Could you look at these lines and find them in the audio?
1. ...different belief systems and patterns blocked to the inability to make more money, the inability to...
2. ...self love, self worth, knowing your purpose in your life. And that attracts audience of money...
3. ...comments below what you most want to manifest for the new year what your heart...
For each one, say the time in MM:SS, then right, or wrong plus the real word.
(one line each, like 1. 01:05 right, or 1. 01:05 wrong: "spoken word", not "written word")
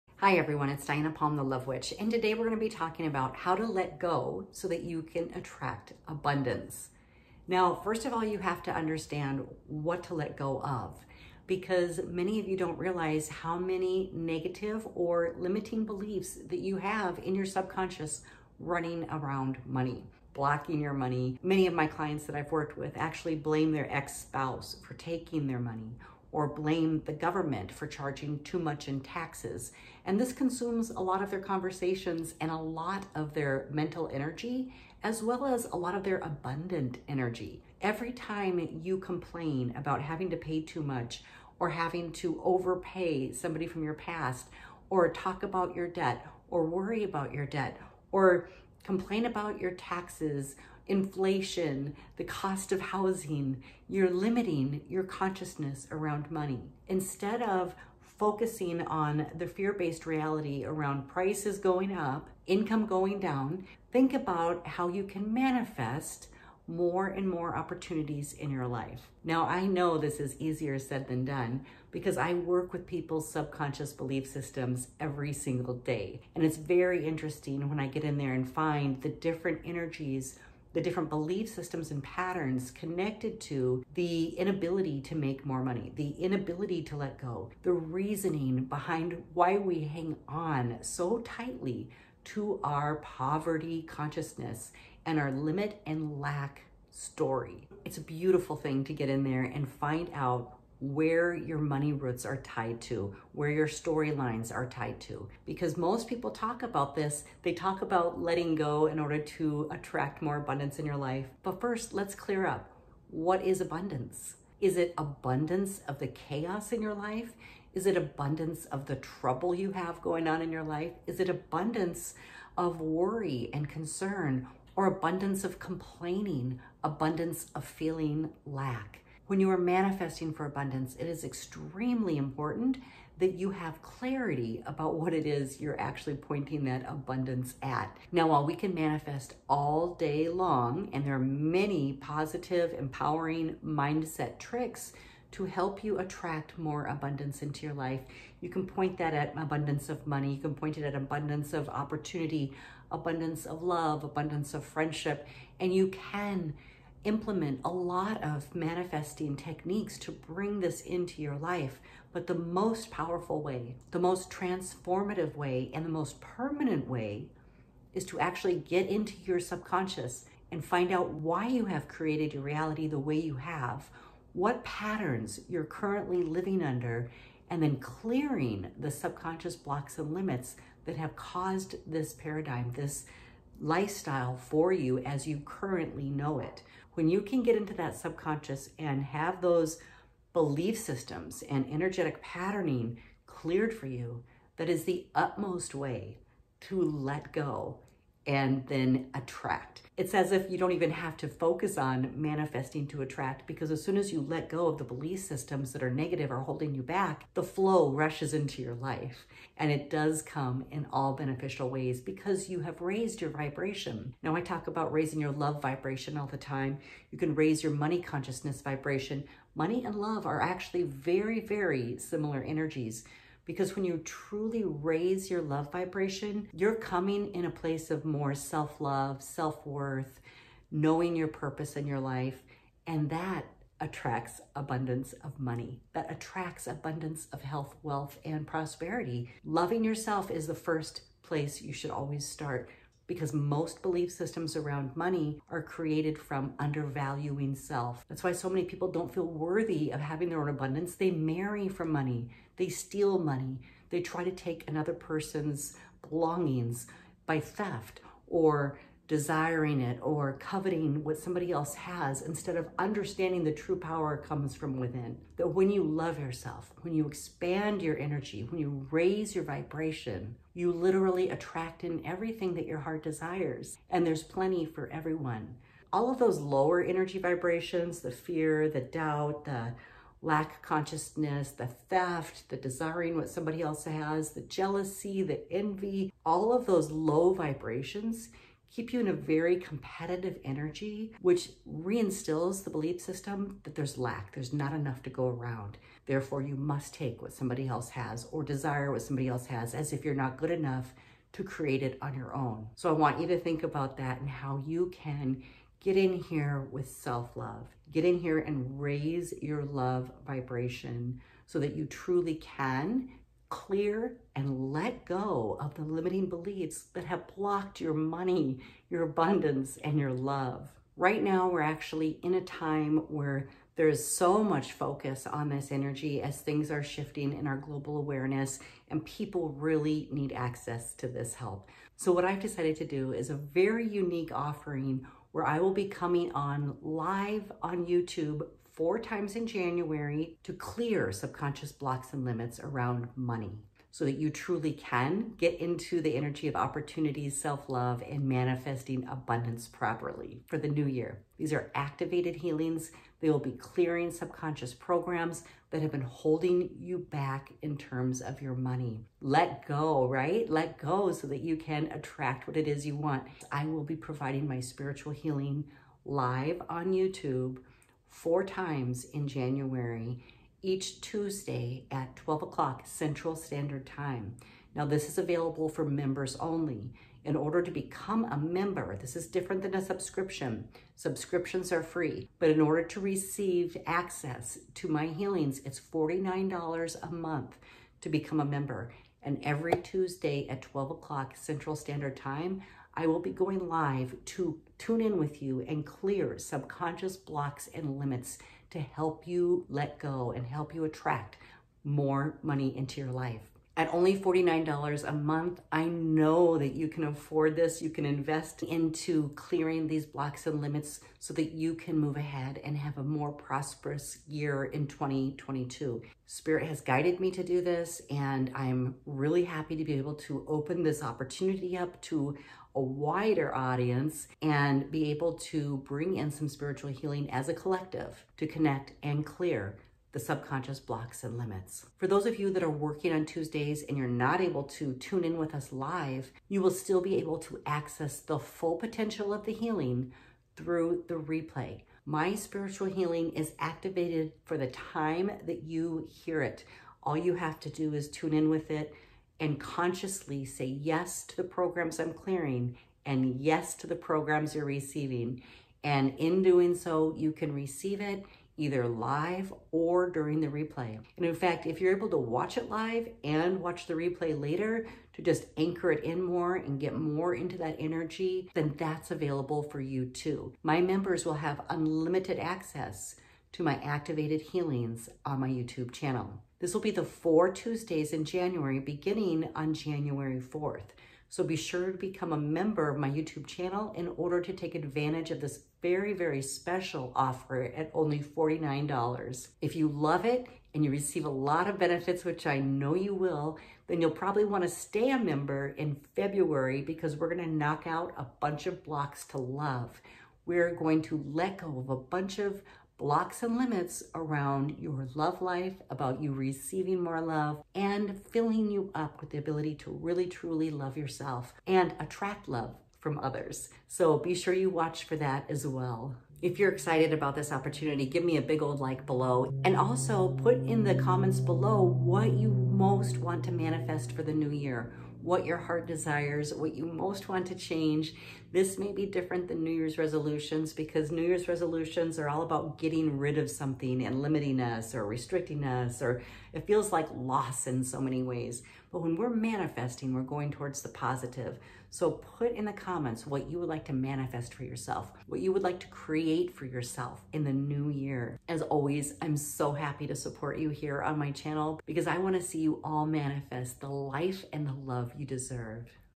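1. 01:20 wrong: "connected", not "blocked"
2. 03:48 wrong: "abundance", not "audience"
3. 08:40 right.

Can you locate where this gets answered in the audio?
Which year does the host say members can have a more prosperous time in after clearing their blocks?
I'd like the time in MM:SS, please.
06:54.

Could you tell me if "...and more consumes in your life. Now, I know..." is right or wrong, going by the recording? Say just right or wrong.
wrong.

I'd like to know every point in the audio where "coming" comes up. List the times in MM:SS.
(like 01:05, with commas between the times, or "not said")
03:46, 05:35.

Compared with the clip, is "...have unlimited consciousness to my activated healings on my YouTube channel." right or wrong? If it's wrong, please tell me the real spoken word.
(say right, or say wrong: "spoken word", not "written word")
wrong: "access", not "consciousness".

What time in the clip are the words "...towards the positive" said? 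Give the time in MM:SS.
09:00.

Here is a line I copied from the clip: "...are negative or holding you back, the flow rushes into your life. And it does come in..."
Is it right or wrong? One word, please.
right.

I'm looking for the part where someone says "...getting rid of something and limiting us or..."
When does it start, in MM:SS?
08:52.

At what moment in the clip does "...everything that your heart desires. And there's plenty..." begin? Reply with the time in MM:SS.
04:32.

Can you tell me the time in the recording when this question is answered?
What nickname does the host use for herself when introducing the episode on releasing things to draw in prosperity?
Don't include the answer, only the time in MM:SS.
00:01.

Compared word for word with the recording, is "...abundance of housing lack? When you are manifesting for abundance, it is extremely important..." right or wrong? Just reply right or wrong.
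wrong.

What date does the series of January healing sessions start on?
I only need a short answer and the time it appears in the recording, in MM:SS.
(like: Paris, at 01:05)
January 4, at 07:59.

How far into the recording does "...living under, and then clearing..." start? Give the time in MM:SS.
02:56.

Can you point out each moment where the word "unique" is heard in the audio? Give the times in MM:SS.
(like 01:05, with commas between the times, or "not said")
05:33.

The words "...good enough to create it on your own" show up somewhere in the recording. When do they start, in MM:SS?
05:00.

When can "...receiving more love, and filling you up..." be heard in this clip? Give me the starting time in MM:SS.
08:26.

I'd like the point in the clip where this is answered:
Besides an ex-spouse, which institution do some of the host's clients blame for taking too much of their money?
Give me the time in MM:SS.
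00:27.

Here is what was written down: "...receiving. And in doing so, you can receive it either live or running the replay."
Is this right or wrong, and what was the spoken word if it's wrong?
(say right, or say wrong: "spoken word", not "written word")
wrong: "during", not "running".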